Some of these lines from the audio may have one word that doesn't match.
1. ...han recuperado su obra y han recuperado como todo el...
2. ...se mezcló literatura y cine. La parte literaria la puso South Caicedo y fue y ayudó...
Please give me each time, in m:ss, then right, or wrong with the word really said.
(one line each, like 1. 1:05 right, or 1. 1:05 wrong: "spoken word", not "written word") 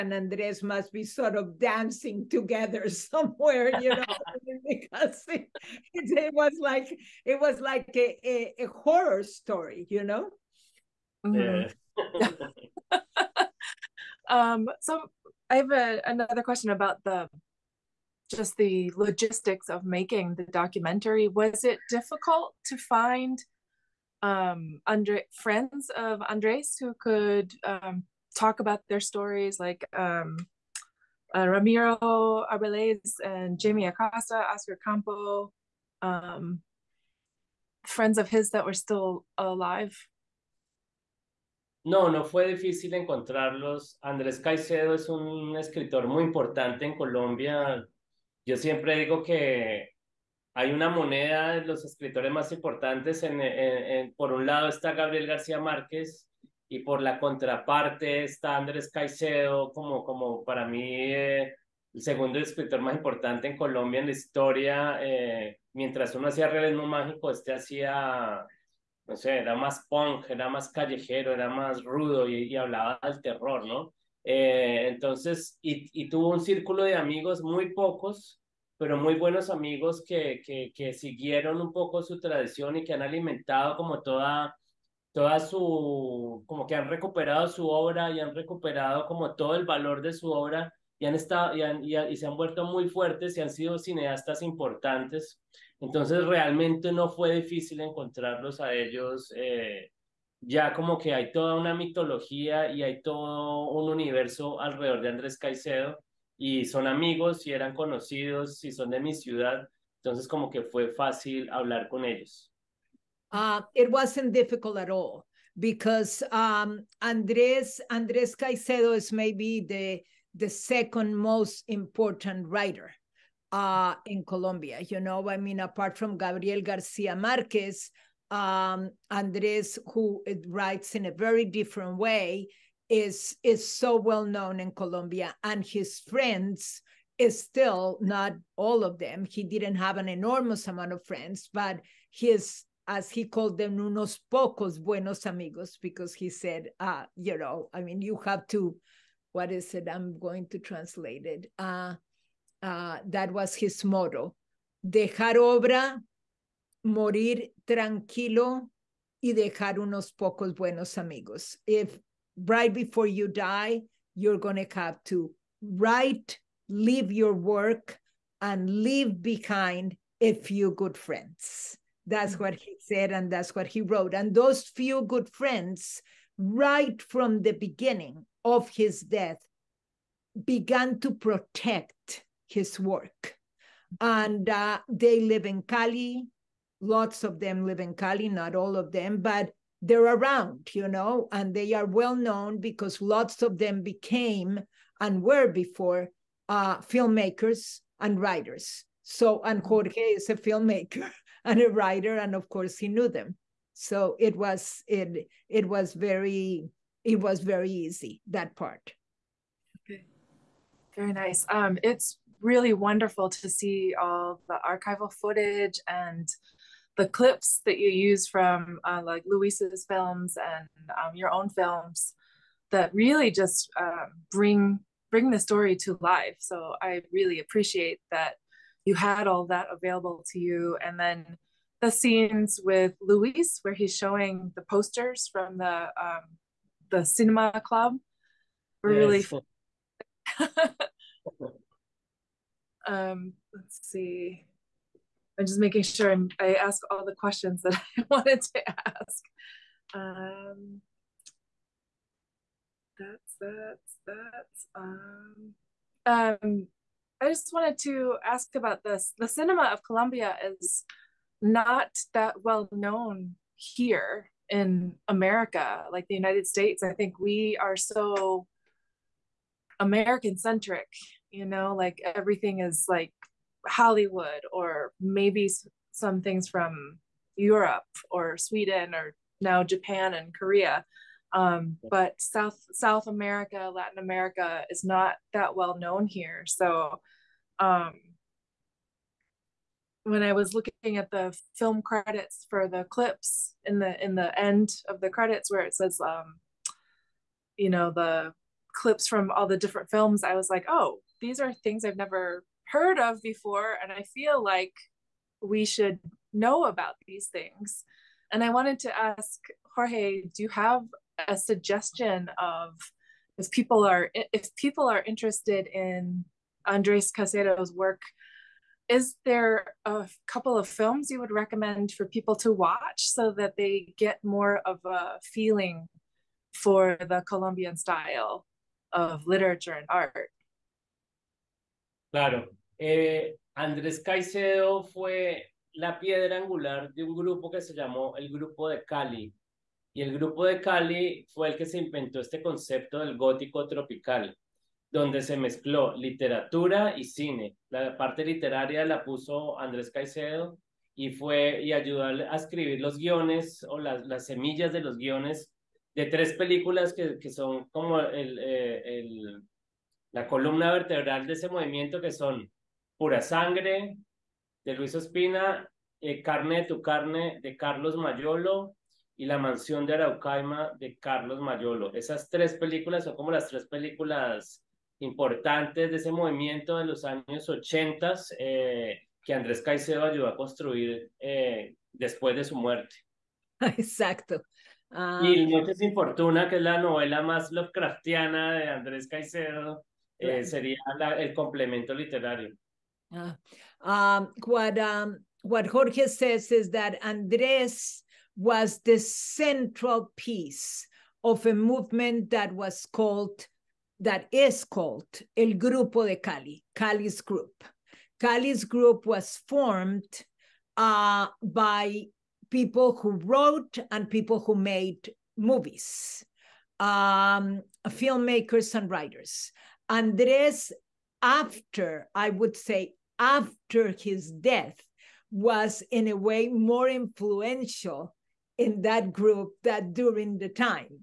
1. 1:26 right
2. 5:45 wrong: "Andrés", not "South".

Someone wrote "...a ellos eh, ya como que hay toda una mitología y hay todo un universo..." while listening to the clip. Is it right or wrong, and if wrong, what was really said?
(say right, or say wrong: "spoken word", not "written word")
right.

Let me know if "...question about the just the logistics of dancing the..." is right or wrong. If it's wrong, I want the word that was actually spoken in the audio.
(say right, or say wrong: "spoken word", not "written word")
wrong: "making", not "dancing".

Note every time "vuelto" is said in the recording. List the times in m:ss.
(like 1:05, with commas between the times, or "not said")
1:32.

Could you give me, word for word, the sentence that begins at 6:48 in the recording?
Cali's group was formed uh, by people who wrote and people who made movies, um, filmmakers and writers.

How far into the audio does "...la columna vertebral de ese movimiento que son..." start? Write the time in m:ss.
6:00.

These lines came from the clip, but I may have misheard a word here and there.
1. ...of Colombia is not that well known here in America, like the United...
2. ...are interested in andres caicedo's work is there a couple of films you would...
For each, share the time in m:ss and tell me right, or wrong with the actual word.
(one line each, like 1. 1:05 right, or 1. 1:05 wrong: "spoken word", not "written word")
1. 4:19 right
2. 5:14 right.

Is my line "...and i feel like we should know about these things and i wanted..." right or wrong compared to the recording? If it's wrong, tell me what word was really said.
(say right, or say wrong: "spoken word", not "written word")
right.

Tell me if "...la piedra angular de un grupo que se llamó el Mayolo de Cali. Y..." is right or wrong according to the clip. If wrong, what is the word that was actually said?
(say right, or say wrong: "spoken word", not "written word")
wrong: "Grupo", not "Mayolo".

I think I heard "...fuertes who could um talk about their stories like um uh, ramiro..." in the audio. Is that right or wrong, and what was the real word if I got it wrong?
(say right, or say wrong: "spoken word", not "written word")
wrong: "andres", not "fuertes".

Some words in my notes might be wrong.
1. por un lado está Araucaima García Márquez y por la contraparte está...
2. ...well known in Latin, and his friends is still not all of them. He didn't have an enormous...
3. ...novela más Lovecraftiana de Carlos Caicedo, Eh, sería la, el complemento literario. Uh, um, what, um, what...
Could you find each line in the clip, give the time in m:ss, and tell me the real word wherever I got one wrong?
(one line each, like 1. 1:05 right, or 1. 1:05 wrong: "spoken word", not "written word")
1. 0:54 wrong: "Gabriel", not "Araucaima"
2. 2:13 wrong: "Colombia", not "Latin"
3. 6:26 wrong: "Andrés", not "Carlos".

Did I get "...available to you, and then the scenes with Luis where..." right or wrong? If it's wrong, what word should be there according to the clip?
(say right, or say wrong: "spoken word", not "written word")
right.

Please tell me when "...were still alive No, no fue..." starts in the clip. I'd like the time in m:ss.
0:38.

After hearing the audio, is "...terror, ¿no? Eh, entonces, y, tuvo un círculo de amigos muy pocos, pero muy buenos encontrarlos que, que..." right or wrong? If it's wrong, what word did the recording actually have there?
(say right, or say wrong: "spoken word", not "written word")
wrong: "amigos", not "encontrarlos".